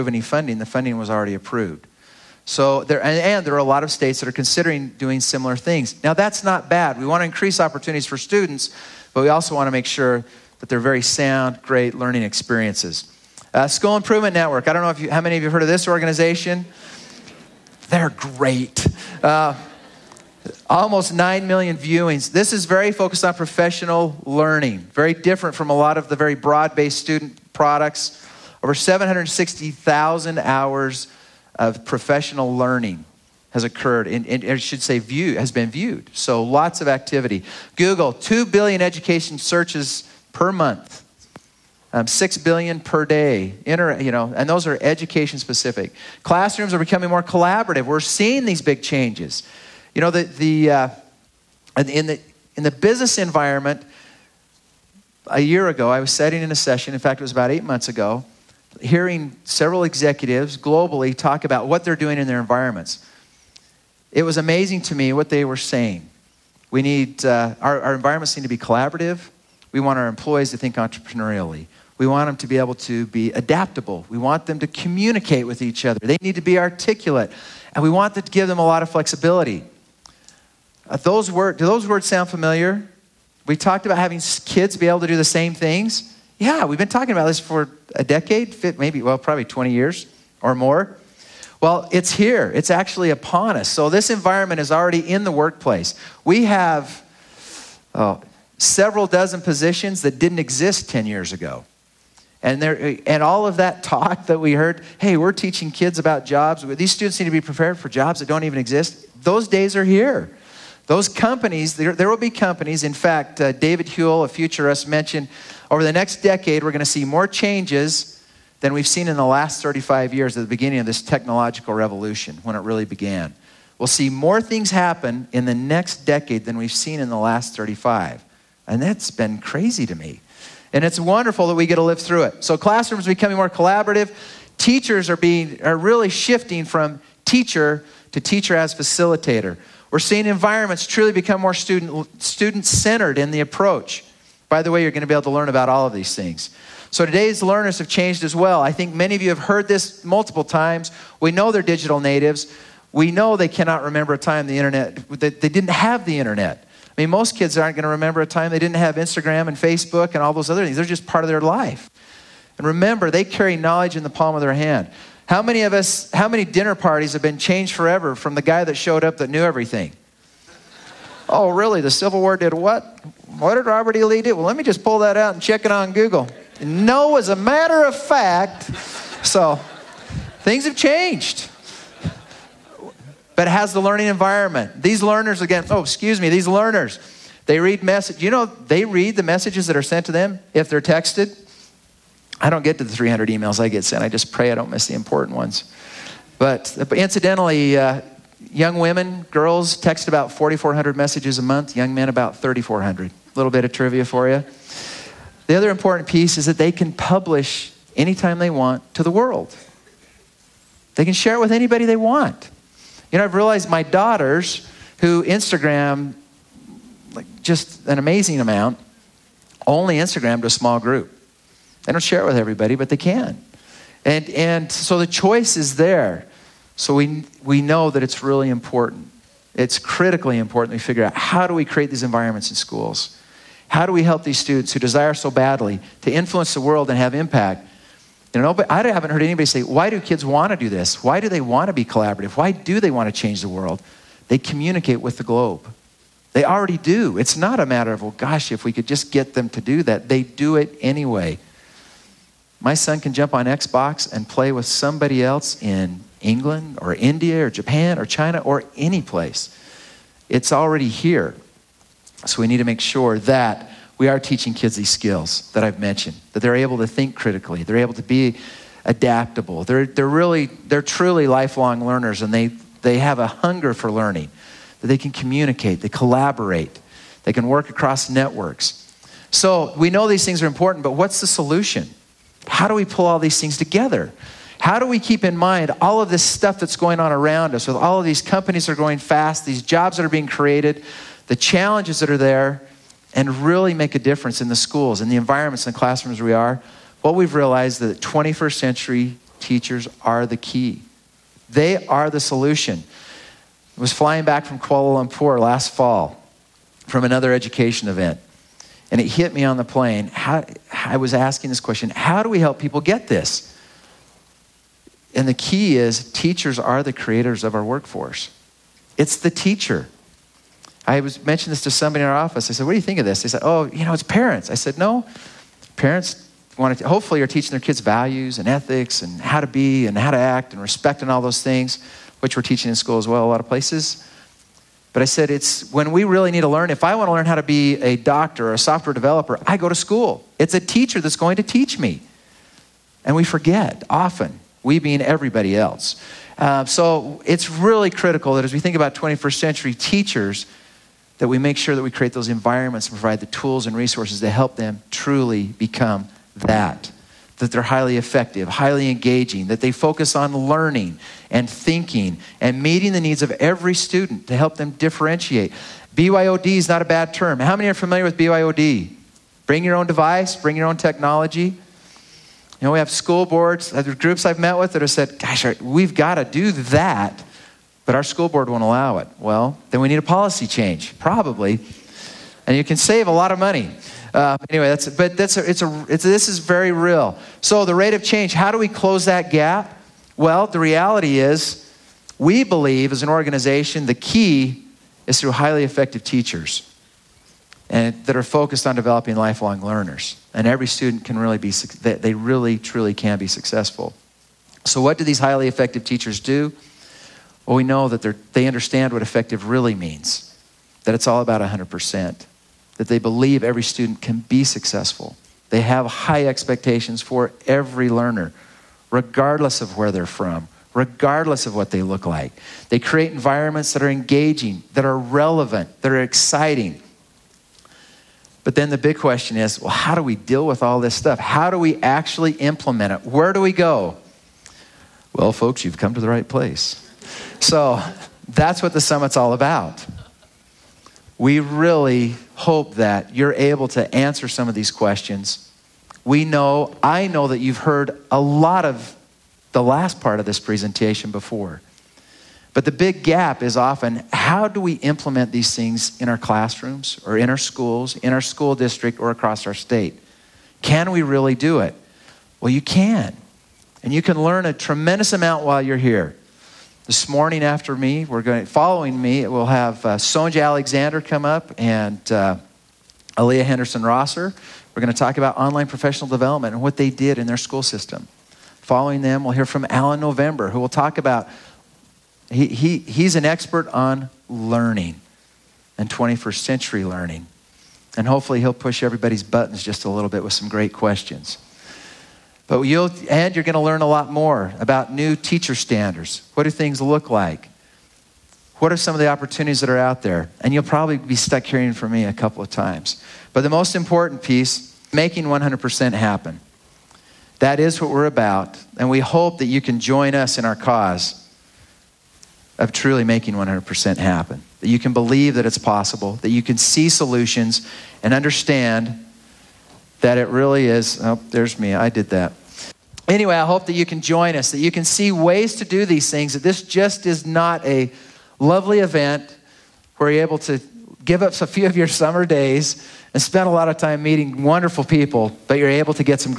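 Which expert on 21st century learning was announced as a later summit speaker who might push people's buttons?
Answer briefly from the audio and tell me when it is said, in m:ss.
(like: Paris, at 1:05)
Alan November, at 7:59.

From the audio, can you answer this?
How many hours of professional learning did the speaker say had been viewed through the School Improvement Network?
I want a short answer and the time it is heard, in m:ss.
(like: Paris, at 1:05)
760,000, at 0:28.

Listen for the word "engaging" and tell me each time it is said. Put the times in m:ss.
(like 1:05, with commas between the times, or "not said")
5:58, 7:03.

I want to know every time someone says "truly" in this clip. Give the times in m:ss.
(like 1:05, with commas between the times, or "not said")
2:20, 4:30, 5:54, 6:42, 8:32.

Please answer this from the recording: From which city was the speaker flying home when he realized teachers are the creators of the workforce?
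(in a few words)
Kuala Lumpur.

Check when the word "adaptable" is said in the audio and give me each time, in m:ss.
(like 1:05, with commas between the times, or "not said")
1:13, 4:28.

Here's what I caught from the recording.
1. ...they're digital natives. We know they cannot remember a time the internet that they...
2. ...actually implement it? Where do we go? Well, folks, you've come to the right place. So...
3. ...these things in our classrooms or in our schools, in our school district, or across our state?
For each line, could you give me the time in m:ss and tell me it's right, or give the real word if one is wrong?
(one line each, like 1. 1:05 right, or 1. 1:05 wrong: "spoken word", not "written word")
1. 2:31 right
2. 7:11 right
3. 7:35 right.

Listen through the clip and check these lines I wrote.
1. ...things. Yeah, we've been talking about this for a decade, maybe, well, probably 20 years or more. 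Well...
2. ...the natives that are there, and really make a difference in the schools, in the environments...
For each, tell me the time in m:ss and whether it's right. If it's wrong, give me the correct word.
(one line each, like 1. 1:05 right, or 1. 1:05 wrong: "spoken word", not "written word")
1. 1:25 right
2. 4:51 wrong: "challenges", not "natives".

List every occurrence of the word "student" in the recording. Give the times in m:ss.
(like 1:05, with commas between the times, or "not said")
0:08, 0:26, 1:46, 2:21, 3:54, 6:03, 6:40, 6:53.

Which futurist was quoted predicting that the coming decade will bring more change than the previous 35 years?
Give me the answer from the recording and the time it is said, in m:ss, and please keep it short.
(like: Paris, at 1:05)
David Houle, at 1:53.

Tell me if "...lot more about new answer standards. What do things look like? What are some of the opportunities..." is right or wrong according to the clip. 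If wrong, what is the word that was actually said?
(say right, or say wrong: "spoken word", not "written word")
wrong: "teacher", not "answer".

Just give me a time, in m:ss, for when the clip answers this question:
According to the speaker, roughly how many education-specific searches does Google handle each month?
0:38.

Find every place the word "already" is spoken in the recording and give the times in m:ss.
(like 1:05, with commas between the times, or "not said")
0:01, 1:34, 4:06, 4:20.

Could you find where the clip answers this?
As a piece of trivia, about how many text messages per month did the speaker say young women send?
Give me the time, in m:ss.
3:20.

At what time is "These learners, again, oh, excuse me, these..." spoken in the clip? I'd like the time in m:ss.
3:04.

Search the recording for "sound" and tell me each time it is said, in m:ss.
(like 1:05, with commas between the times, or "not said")
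0:11, 1:22.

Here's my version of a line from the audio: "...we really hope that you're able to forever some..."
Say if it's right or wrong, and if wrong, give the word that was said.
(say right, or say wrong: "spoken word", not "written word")
wrong: "answer", not "forever".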